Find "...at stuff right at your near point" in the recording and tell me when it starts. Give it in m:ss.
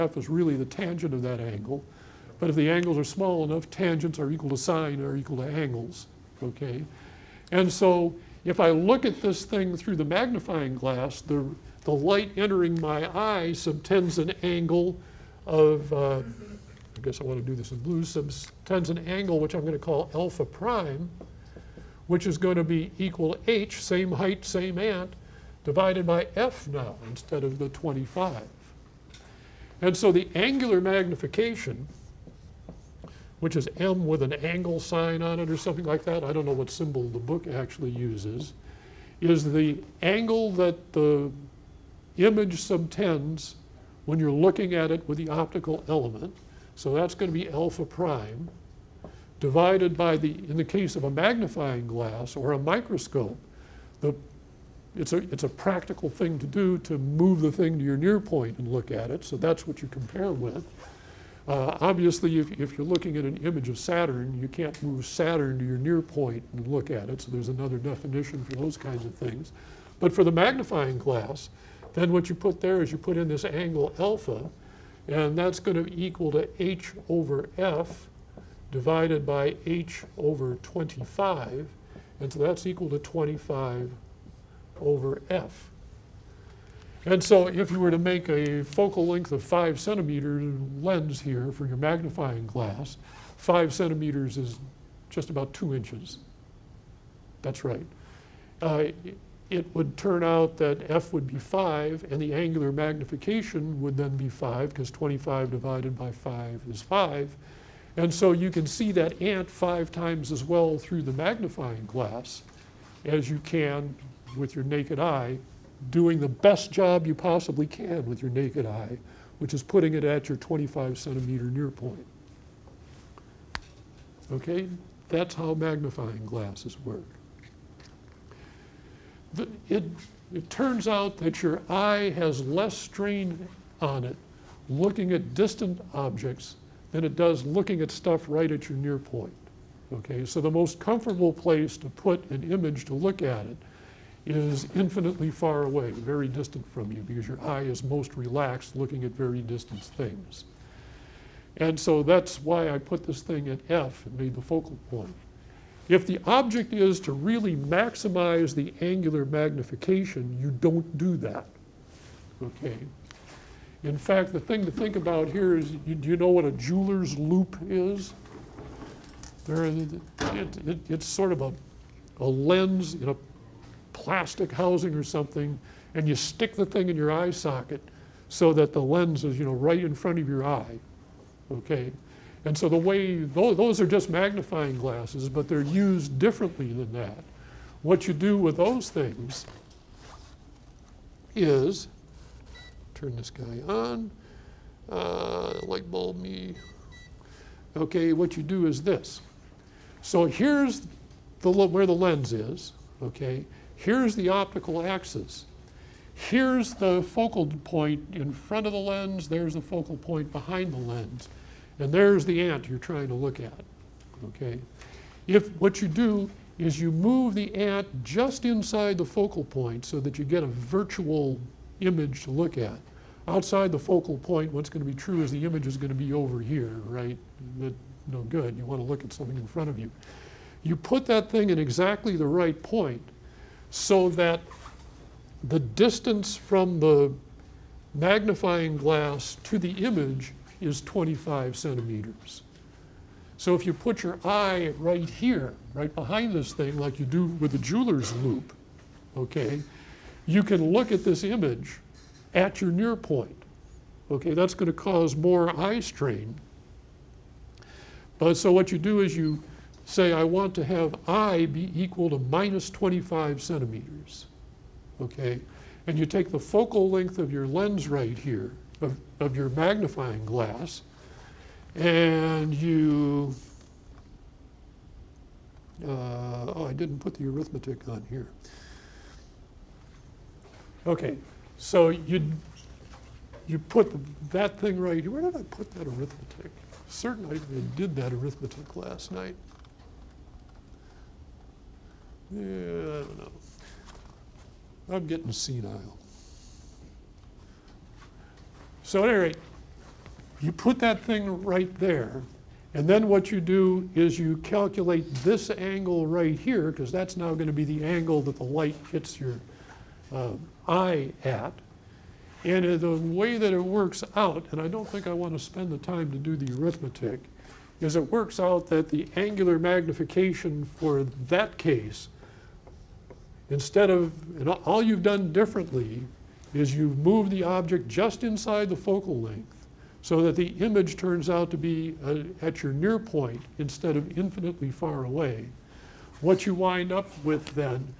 2:17.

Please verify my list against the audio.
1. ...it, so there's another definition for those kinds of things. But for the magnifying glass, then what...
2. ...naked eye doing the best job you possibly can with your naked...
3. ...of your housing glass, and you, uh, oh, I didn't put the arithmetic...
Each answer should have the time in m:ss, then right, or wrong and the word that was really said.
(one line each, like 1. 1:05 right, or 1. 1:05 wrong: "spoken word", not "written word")
1. 1:07 right
2. 1:54 right
3. 4:29 wrong: "magnifying", not "housing".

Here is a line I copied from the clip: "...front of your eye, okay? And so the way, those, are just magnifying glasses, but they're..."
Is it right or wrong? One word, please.
right.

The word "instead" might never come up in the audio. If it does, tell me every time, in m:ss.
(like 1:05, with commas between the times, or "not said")
0:27, 5:23, 5:33.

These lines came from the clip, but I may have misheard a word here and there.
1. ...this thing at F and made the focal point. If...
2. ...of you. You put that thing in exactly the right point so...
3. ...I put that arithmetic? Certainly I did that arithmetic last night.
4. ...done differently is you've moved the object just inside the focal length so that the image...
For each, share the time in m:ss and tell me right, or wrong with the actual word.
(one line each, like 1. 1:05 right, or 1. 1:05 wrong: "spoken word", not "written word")
1. 2:33 right
2. 3:49 right
3. 4:45 right
4. 5:25 right.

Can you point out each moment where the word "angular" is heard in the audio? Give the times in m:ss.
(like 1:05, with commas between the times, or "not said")
0:30, 1:42, 2:38, 5:19.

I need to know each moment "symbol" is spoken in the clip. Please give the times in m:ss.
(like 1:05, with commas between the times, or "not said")
0:36.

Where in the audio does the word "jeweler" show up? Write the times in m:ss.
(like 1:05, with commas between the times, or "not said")
2:46, 4:07.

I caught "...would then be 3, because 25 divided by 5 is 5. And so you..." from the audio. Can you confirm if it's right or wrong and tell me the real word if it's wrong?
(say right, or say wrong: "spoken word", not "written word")
wrong: "5", not "3".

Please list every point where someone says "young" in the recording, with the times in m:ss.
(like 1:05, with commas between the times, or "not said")
not said.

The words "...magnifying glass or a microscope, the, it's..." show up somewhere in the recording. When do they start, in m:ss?
0:51.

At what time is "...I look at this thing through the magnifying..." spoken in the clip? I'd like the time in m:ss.
0:08.